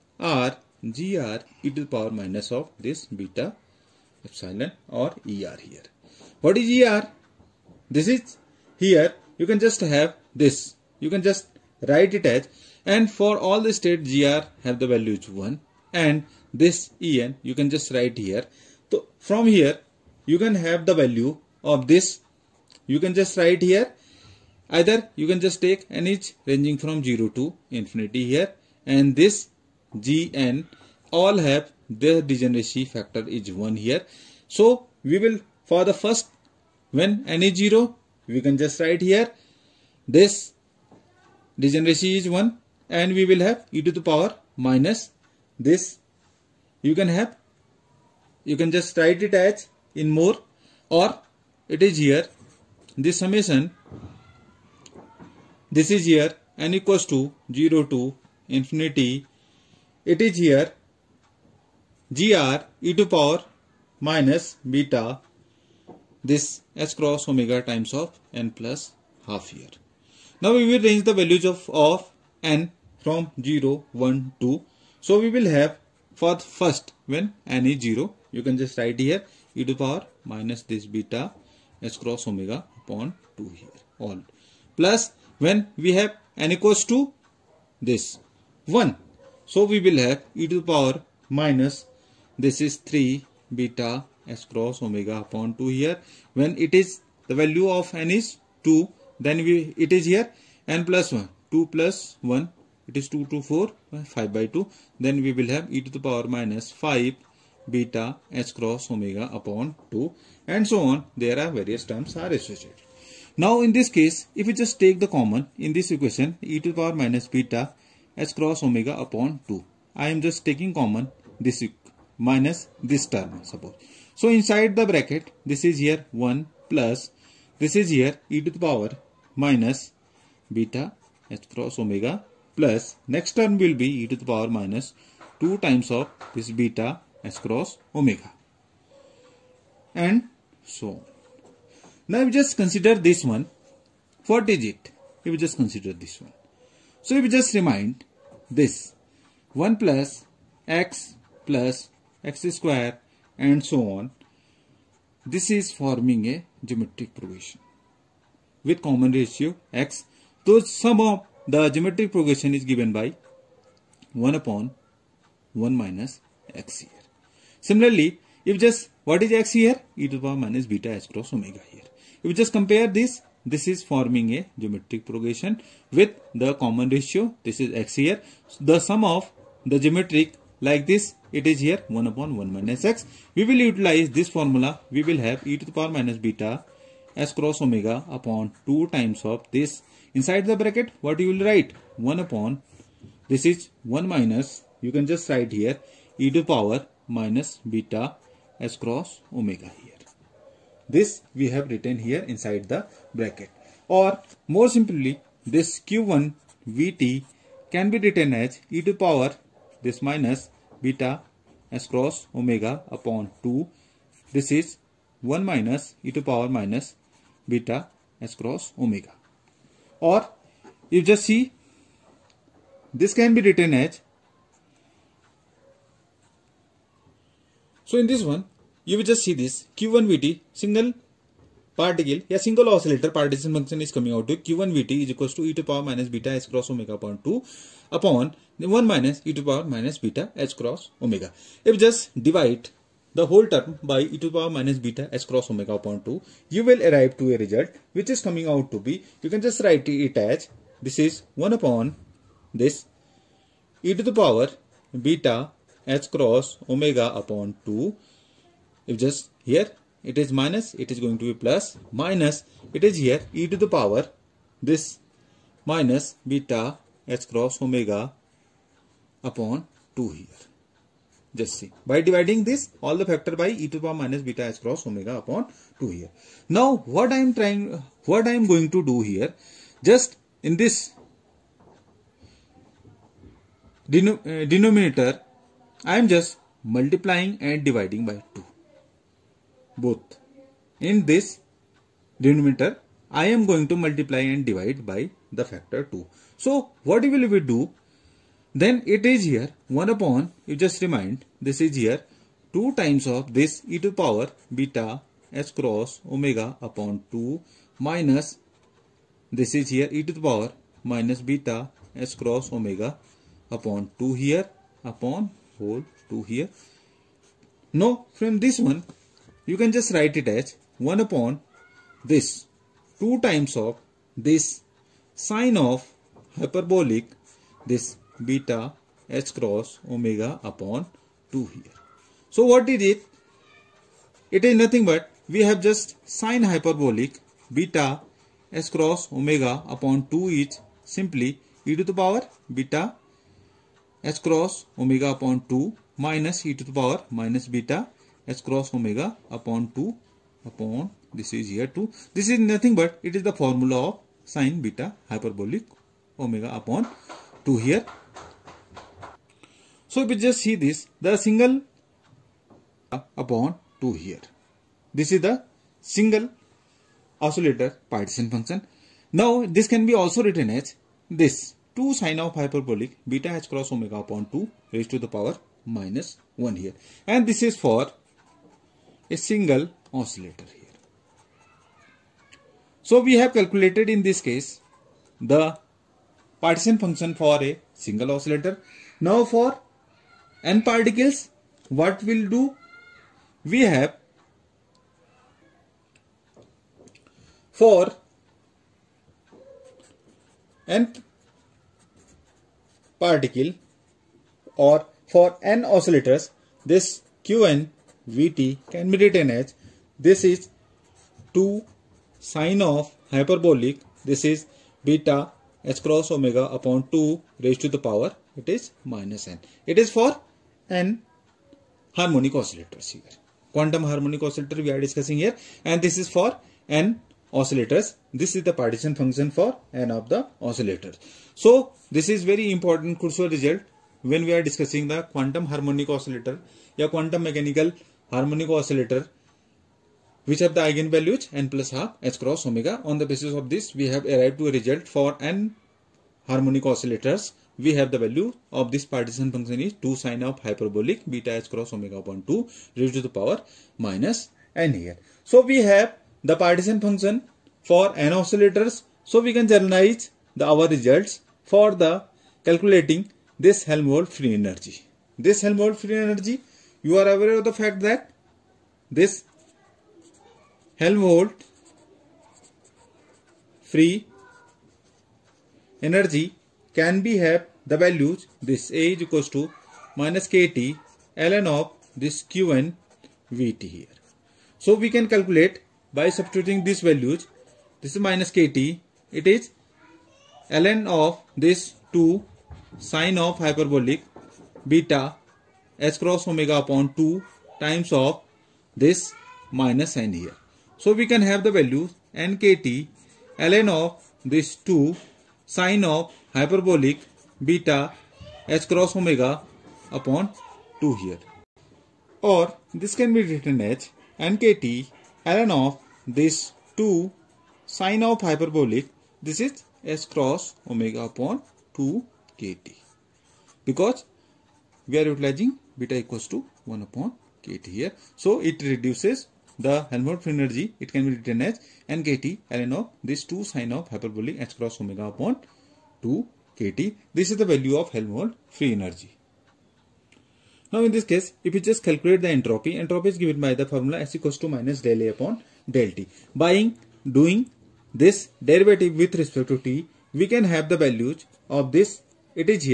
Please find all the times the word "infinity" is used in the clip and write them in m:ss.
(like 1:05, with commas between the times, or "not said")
0:27, 0:58.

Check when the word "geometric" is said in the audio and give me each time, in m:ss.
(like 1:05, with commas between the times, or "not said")
2:36, 2:41, 2:54, 2:59.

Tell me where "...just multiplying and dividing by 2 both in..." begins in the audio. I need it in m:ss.
4:46.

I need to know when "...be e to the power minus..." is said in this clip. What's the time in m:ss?
2:13.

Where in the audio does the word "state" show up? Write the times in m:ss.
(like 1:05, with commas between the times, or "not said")
0:13.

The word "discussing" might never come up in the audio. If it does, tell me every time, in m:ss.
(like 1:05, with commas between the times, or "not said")
7:04, 7:14.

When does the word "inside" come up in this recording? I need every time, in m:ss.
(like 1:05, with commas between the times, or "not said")
2:04, 3:10, 3:22.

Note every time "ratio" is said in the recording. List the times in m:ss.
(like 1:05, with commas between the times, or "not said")
2:39, 2:56.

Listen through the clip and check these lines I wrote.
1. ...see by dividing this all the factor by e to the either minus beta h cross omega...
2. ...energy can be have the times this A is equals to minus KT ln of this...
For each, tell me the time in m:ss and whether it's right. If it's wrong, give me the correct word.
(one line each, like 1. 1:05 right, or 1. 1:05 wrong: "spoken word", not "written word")
1. 4:31 wrong: "power", not "either"
2. 7:55 wrong: "values", not "times".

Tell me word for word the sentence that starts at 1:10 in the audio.
Now we will range the values of, of n from 0, 1, 2.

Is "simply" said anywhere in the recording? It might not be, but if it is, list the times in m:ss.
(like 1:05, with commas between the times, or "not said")
3:24, 5:40.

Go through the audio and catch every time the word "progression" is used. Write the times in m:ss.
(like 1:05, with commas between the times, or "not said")
2:37, 2:42, 2:55.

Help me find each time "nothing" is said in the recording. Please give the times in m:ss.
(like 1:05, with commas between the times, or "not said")
5:34, 5:52.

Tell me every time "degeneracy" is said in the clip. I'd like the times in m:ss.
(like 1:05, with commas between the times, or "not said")
0:32, 0:41.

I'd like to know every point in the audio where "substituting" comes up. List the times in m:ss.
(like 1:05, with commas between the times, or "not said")
8:06.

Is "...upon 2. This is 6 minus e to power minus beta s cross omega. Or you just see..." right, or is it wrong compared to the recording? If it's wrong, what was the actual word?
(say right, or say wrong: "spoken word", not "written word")
wrong: "1", not "6".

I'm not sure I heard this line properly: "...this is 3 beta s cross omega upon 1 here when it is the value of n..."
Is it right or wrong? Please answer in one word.
wrong.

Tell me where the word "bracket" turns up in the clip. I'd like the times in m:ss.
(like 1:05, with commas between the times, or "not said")
2:04, 3:10, 3:23.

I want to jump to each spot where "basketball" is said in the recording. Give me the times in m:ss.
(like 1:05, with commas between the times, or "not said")
not said.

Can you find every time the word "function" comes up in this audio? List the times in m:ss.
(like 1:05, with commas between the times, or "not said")
3:53, 6:08, 6:26, 7:08, 7:29, 7:36.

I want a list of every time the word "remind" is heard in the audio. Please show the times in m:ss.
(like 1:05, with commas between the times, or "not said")
2:27, 5:00.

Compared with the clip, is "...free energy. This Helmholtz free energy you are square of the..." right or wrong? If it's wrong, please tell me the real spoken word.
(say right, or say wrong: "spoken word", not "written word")
wrong: "aware", not "square".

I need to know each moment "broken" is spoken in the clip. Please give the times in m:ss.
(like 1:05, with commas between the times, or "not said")
not said.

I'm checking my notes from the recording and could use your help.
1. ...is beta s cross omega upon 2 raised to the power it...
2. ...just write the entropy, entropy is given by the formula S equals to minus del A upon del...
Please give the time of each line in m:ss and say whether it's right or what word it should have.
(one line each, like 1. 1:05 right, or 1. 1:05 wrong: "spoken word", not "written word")
1. 6:54 right
2. 9:01 wrong: "calculate", not "write".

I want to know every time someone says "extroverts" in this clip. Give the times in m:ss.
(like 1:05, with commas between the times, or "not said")
not said.